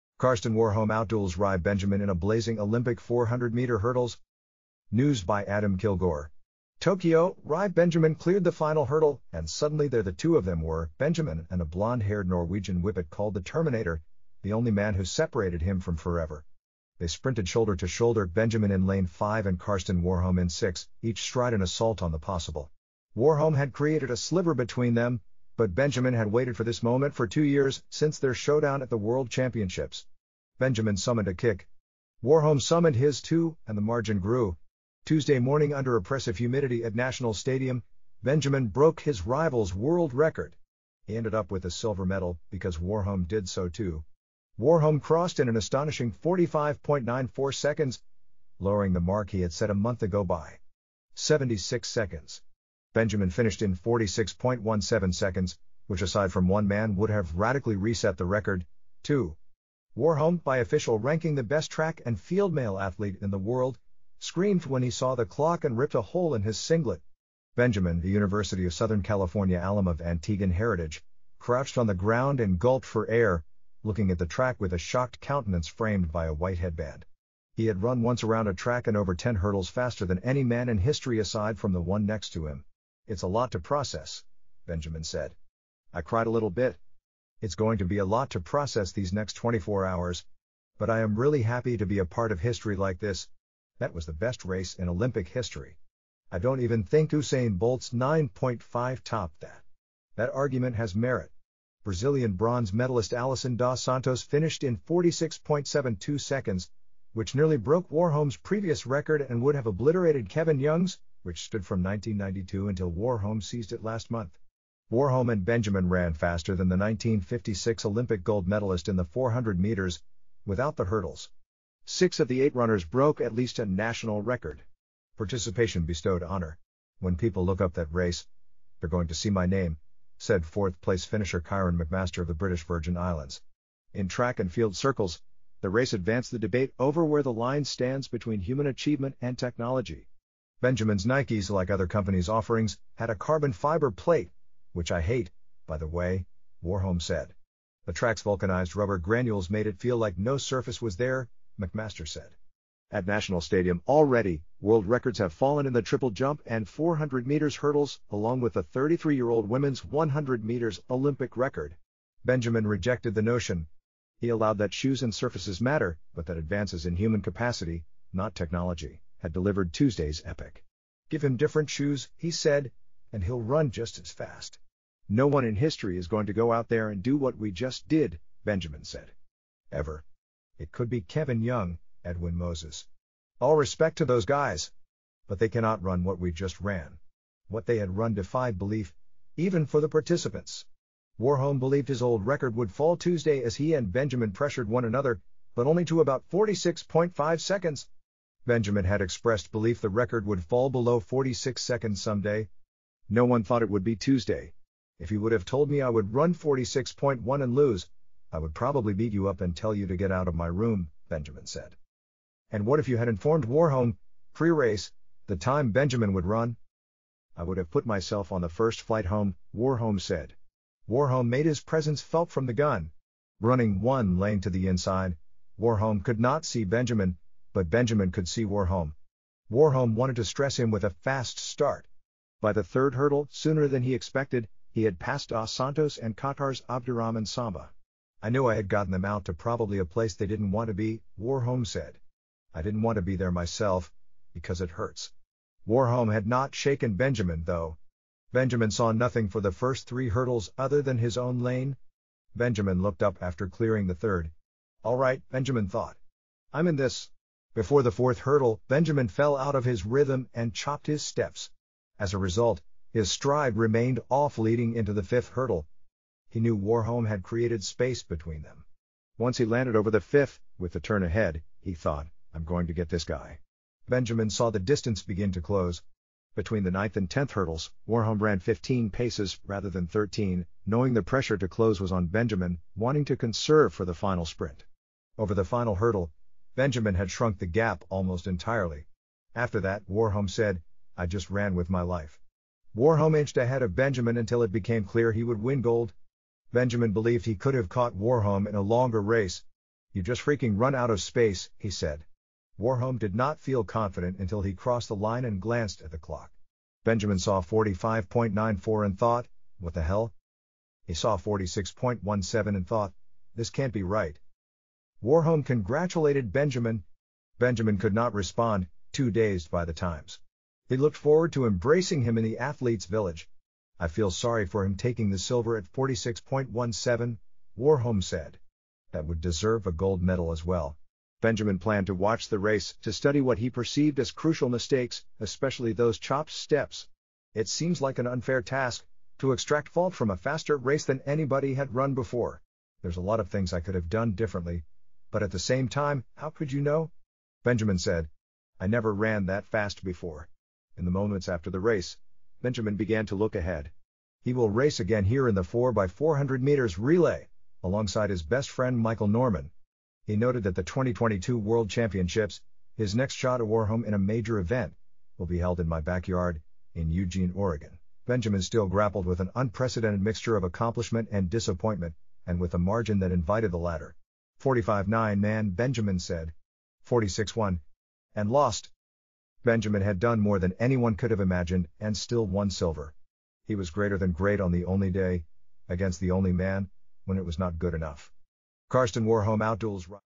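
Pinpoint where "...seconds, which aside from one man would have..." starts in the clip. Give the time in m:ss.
0:55.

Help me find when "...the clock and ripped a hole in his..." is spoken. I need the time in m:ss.
1:05.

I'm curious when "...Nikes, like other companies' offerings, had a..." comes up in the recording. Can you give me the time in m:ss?
2:21.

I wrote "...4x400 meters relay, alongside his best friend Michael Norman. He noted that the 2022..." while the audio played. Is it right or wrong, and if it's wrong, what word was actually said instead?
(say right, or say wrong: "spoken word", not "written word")
right.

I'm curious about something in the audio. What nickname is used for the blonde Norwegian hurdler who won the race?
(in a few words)
the Terminator.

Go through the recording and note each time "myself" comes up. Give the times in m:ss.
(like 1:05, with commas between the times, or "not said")
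3:37, 4:03.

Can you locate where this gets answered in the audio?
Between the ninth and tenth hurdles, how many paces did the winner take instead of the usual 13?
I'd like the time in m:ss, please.
4:38.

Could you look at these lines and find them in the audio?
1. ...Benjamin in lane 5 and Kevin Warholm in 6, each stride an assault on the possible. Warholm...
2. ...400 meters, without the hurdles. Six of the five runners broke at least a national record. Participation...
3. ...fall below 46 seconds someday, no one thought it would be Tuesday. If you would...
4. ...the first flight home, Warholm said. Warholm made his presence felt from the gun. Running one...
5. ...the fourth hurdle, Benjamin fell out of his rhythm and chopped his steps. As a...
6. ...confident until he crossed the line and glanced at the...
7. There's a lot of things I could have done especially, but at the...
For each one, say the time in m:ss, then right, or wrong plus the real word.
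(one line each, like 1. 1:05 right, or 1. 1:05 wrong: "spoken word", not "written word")
1. 0:18 wrong: "Karsten", not "Kevin"
2. 1:59 wrong: "eight", not "five"
3. 3:20 right
4. 3:38 right
5. 4:17 right
6. 5:03 right
7. 5:42 wrong: "differently", not "especially".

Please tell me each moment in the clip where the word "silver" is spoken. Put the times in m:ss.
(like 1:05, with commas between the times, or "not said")
0:41, 5:25, 6:22.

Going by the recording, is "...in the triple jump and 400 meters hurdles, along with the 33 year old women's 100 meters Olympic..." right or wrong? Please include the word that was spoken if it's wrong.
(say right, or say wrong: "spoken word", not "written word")
right.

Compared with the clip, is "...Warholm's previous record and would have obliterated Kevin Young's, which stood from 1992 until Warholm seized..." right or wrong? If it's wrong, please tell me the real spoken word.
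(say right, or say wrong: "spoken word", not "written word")
right.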